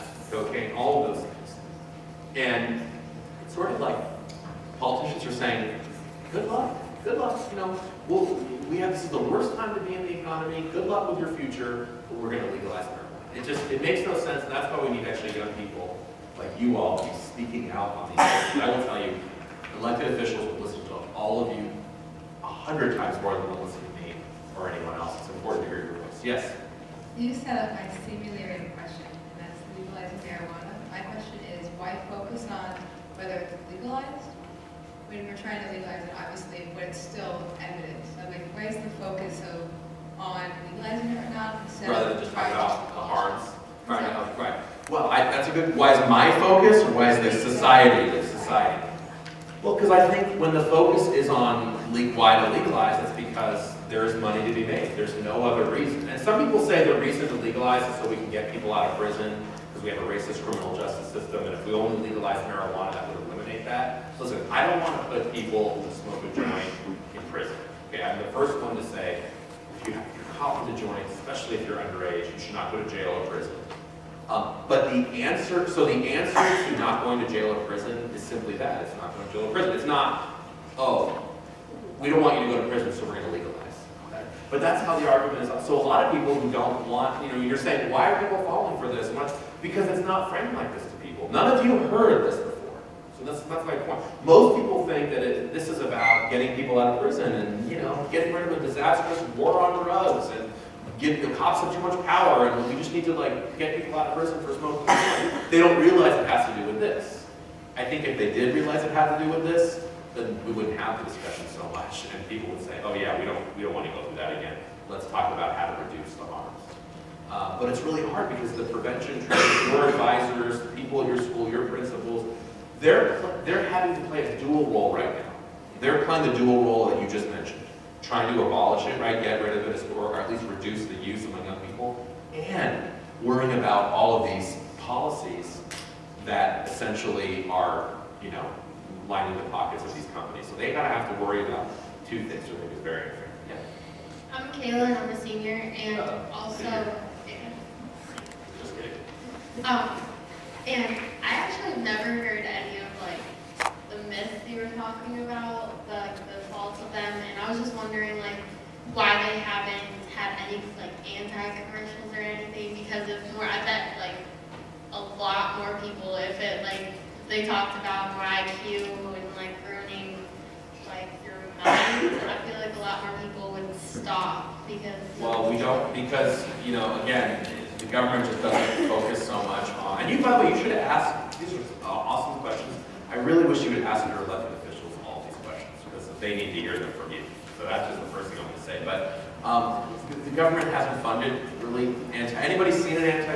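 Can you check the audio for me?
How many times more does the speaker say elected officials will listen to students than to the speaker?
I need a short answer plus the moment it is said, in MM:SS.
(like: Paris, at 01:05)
100, at 00:22.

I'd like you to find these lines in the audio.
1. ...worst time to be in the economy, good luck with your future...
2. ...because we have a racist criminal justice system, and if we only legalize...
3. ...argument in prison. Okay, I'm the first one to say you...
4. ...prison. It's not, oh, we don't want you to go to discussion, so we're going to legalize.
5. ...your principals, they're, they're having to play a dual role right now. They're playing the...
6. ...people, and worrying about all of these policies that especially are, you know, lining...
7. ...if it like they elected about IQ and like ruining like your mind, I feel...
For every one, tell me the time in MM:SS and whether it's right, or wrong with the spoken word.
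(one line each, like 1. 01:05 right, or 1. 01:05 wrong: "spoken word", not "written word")
1. 00:09 right
2. 00:59 right
3. 01:06 wrong: "joint", not "argument"
4. 01:19 wrong: "prison", not "discussion"
5. 02:01 right
6. 02:11 wrong: "essentially", not "especially"
7. 02:46 wrong: "talked", not "elected".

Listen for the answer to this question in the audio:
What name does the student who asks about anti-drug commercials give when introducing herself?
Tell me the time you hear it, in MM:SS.
02:24.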